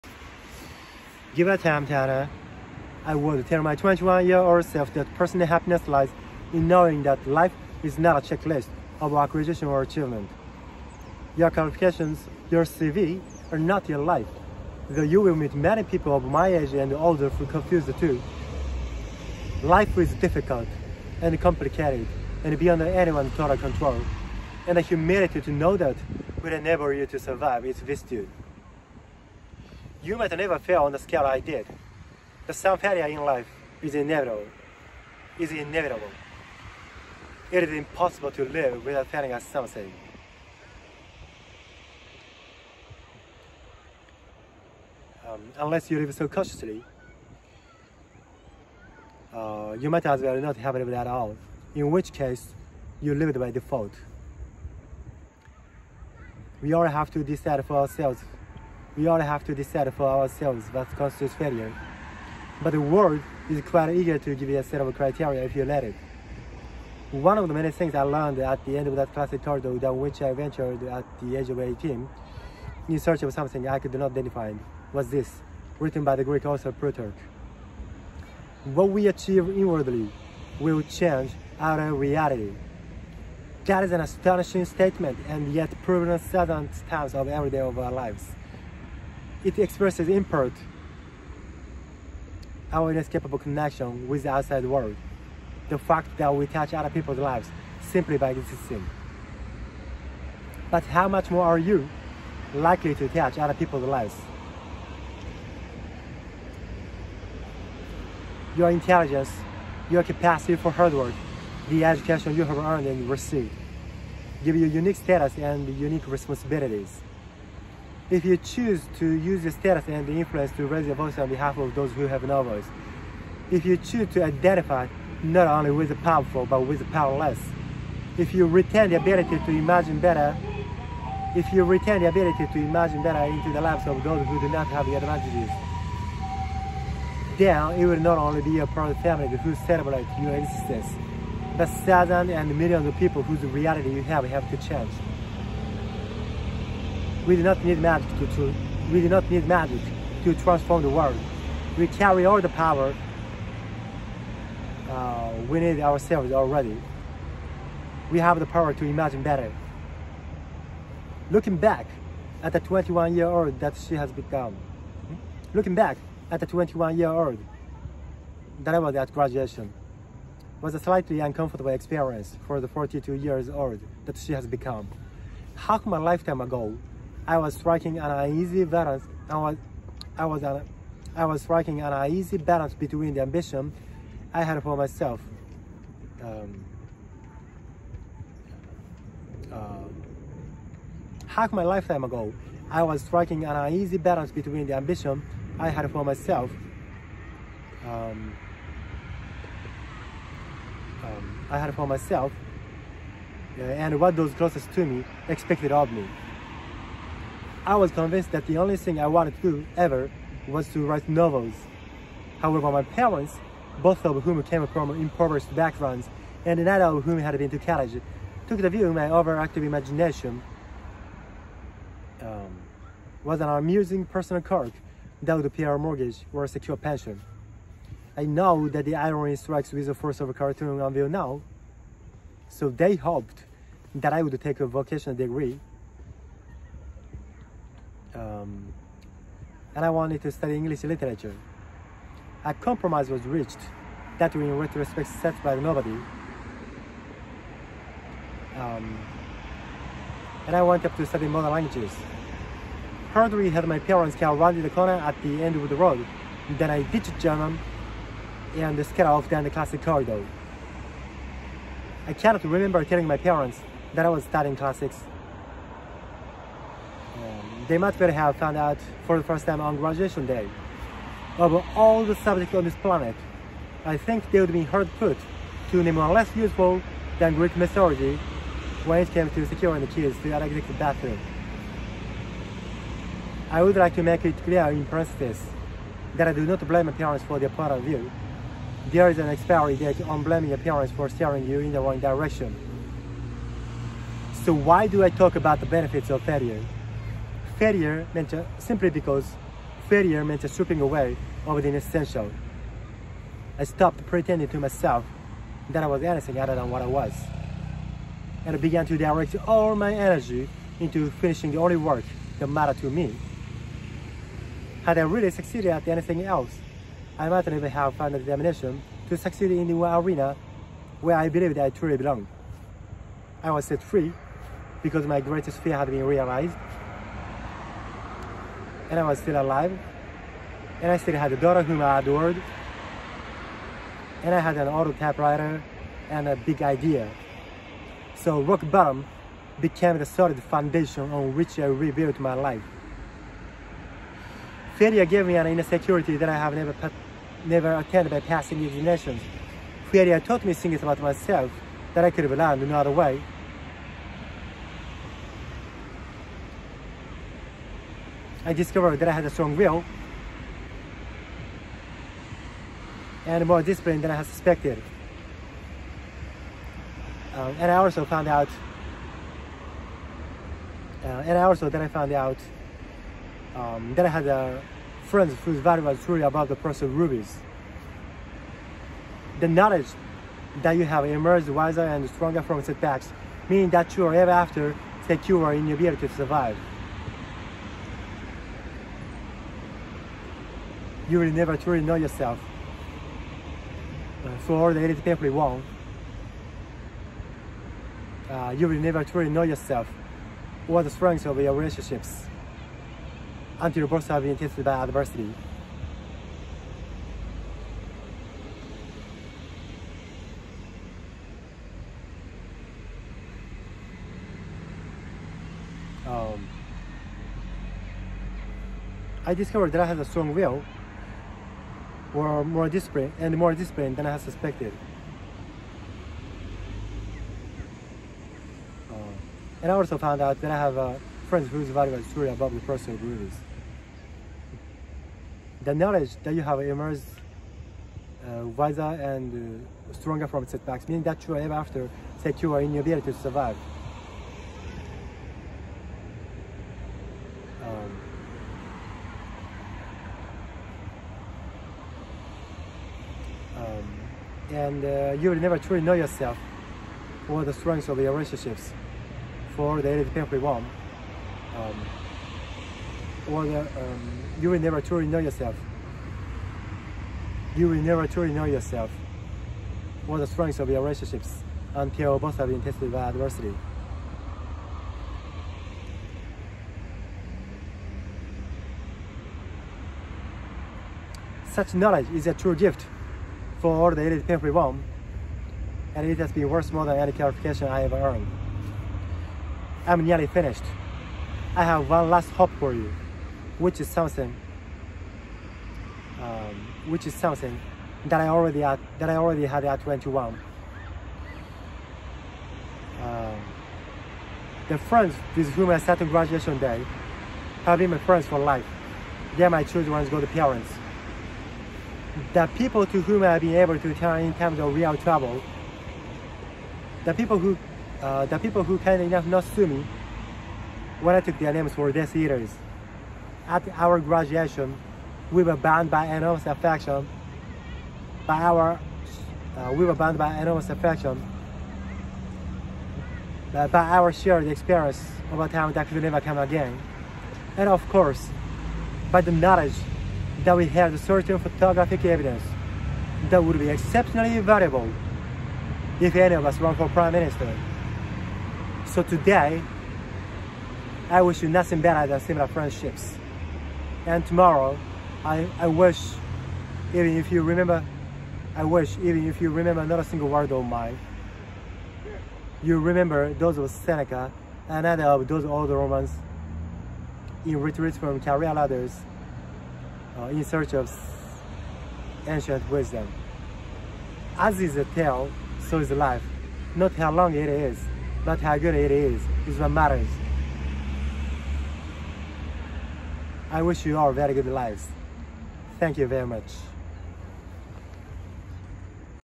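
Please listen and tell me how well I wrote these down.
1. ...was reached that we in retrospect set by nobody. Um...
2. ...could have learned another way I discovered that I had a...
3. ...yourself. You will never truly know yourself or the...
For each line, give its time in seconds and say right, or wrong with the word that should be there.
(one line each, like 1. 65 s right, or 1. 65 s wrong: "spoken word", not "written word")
1. 243 s right
2. 352 s right
3. 465 s right.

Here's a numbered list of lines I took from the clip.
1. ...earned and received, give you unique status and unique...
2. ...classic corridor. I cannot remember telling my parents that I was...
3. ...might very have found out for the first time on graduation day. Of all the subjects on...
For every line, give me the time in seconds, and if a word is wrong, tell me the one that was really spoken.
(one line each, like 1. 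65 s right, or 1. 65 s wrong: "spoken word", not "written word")
1. 112 s right
2. 259 s right
3. 267 s right.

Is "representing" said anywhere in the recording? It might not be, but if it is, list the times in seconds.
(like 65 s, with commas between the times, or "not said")
not said.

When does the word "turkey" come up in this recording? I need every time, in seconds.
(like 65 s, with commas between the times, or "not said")
not said.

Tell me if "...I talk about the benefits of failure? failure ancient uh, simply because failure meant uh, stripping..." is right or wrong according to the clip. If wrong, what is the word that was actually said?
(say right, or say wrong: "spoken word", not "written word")
wrong: "meant", not "ancient".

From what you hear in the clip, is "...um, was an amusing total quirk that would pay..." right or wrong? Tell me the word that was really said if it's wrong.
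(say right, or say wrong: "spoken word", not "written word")
wrong: "personal", not "total".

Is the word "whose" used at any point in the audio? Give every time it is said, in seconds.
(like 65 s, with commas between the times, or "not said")
143 s, 375 s, 431 s.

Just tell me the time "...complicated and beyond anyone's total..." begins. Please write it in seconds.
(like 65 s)
21 s.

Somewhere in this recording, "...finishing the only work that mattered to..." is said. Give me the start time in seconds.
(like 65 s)
311 s.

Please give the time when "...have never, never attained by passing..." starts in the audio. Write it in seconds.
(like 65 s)
346 s.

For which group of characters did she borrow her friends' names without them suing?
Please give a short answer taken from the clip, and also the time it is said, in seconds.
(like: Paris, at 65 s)
Death Eaters, at 521 s.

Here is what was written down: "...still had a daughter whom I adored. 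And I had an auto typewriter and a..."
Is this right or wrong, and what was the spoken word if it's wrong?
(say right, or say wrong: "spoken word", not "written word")
right.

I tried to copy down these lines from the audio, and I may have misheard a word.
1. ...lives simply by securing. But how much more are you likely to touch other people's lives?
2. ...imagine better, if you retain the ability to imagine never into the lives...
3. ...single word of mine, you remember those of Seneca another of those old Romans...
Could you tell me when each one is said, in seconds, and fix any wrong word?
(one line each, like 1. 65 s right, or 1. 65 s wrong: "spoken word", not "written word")
1. 97 s wrong: "existing", not "securing"
2. 129 s wrong: "better", not "never"
3. 560 s right.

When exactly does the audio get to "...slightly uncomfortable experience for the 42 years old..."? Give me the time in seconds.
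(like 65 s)
170 s.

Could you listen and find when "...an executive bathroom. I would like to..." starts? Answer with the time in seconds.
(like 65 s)
280 s.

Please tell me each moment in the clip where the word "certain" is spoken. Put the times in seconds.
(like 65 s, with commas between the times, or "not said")
86 s, 540 s.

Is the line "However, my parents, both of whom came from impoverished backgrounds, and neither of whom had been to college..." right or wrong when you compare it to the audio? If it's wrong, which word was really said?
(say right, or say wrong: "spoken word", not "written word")
right.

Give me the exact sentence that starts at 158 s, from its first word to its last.
We have the power to imagine better.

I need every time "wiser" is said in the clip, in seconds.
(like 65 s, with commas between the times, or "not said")
381 s, 438 s.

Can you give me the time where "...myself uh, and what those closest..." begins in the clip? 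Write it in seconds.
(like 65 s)
201 s.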